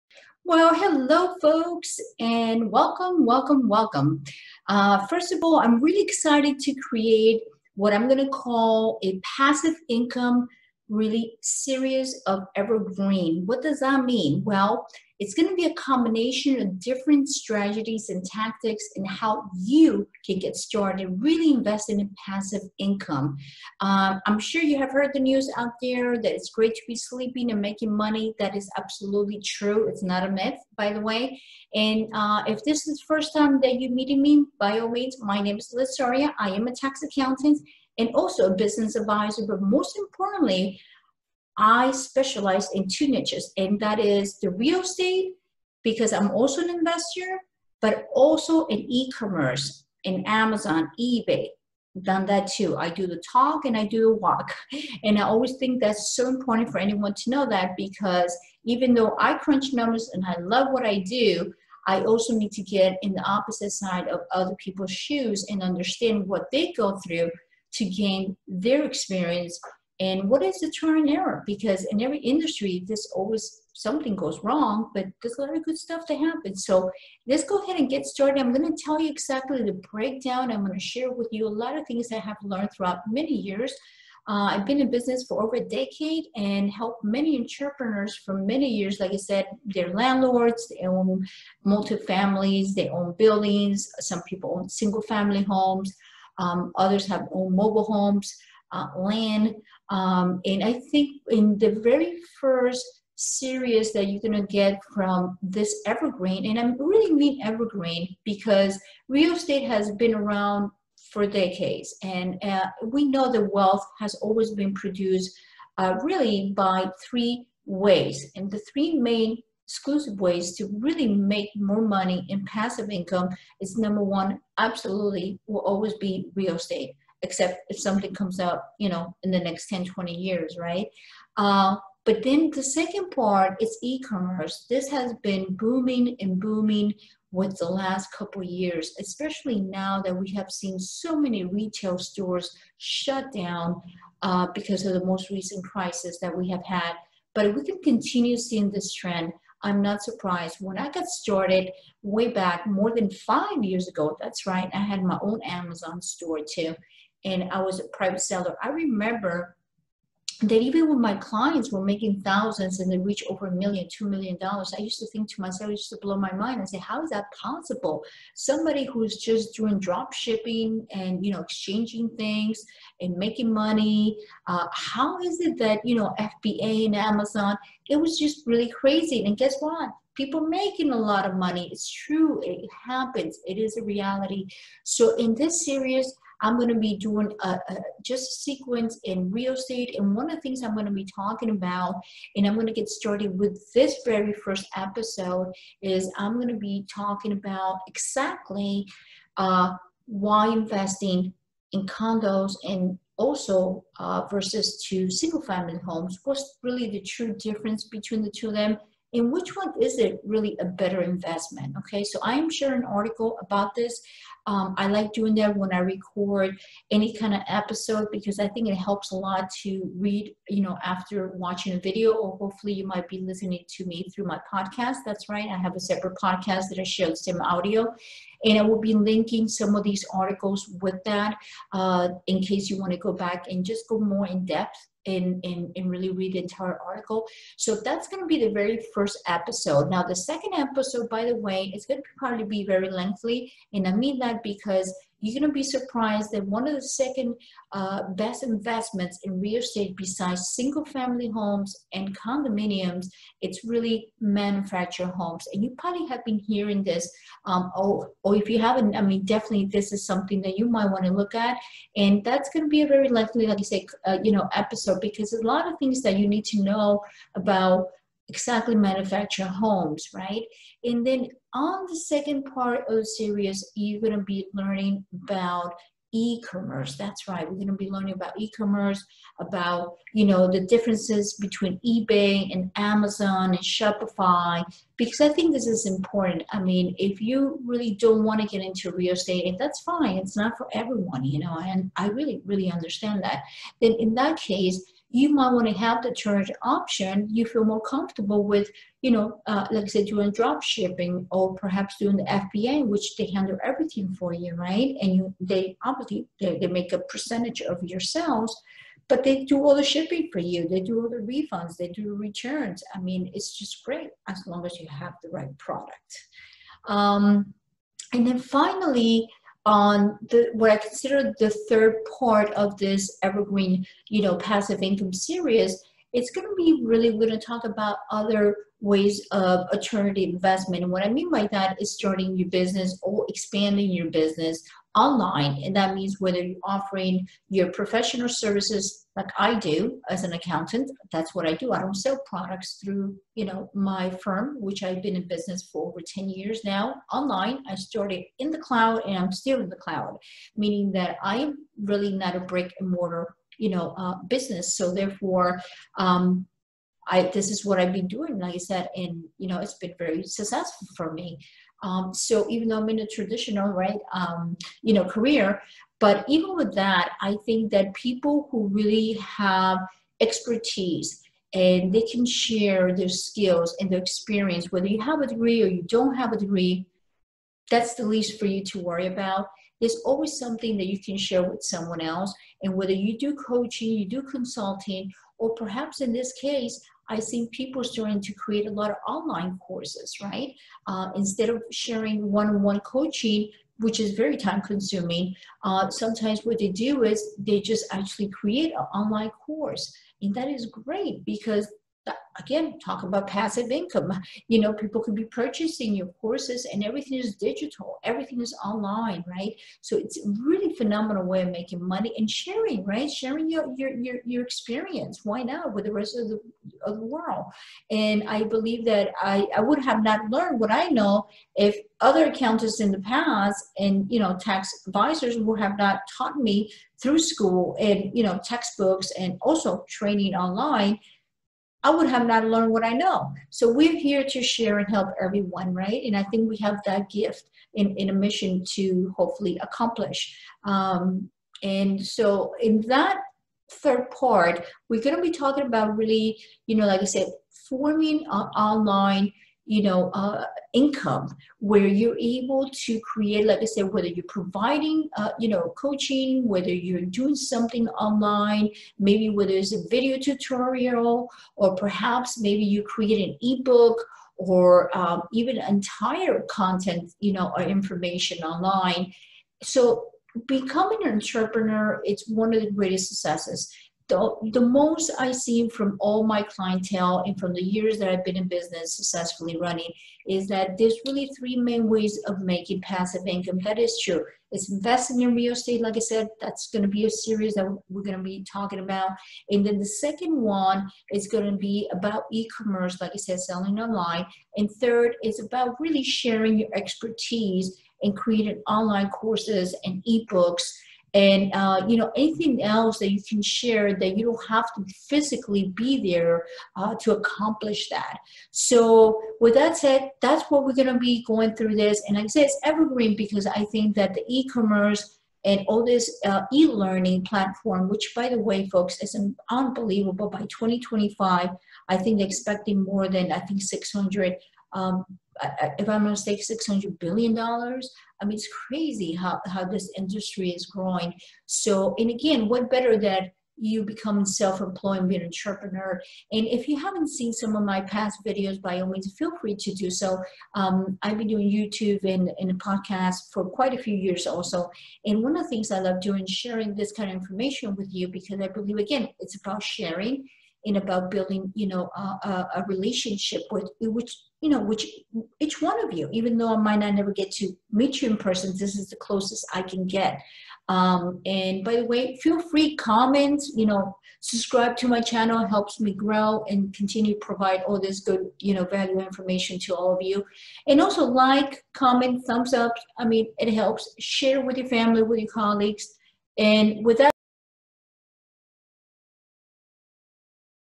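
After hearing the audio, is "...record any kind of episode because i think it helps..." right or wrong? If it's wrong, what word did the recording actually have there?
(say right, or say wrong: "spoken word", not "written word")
right.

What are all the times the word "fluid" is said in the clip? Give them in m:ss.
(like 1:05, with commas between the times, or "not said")
not said.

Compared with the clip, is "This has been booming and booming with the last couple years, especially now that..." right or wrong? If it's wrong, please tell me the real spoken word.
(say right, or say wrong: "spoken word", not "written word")
right.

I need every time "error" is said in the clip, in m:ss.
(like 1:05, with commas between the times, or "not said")
1:11.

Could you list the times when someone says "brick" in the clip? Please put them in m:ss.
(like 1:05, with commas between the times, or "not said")
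5:52.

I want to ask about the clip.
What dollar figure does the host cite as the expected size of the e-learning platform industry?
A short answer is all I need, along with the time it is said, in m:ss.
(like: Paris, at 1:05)
600 billion dollars, at 8:46.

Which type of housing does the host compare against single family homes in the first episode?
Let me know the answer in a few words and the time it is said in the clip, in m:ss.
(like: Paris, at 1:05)
condos, at 3:21.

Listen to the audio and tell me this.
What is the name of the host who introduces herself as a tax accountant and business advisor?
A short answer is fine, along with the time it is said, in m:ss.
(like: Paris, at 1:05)
Liz Soria, at 0:35.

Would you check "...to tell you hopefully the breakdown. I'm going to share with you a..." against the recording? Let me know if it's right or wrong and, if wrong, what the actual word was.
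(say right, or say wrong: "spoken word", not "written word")
wrong: "exactly", not "hopefully".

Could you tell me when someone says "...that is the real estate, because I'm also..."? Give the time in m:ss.
0:43.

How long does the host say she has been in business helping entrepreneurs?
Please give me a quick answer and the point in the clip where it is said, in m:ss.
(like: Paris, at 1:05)
over a decade, at 1:25.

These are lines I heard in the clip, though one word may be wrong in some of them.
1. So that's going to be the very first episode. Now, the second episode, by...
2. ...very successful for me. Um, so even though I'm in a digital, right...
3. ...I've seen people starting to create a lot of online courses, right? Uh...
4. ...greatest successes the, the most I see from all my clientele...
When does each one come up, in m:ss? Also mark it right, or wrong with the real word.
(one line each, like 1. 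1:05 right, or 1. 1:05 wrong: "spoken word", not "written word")
1. 3:57 right
2. 5:59 wrong: "traditional", not "digital"
3. 6:27 right
4. 7:52 right.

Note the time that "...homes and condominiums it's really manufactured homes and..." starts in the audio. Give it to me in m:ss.
4:11.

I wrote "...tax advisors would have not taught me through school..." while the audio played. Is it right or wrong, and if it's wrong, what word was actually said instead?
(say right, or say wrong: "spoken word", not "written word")
right.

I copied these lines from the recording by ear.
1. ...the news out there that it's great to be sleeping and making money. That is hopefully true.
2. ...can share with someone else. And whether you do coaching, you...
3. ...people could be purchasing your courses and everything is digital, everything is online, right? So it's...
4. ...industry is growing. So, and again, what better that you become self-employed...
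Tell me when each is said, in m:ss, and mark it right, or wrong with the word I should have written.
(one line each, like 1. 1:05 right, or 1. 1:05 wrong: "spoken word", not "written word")
1. 0:25 wrong: "absolutely", not "hopefully"
2. 6:20 right
3. 6:44 right
4. 8:49 right.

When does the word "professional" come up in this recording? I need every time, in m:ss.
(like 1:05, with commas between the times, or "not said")
5:37.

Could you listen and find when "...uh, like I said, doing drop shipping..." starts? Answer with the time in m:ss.
4:59.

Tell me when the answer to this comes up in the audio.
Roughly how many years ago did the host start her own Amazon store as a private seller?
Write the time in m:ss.
2:32.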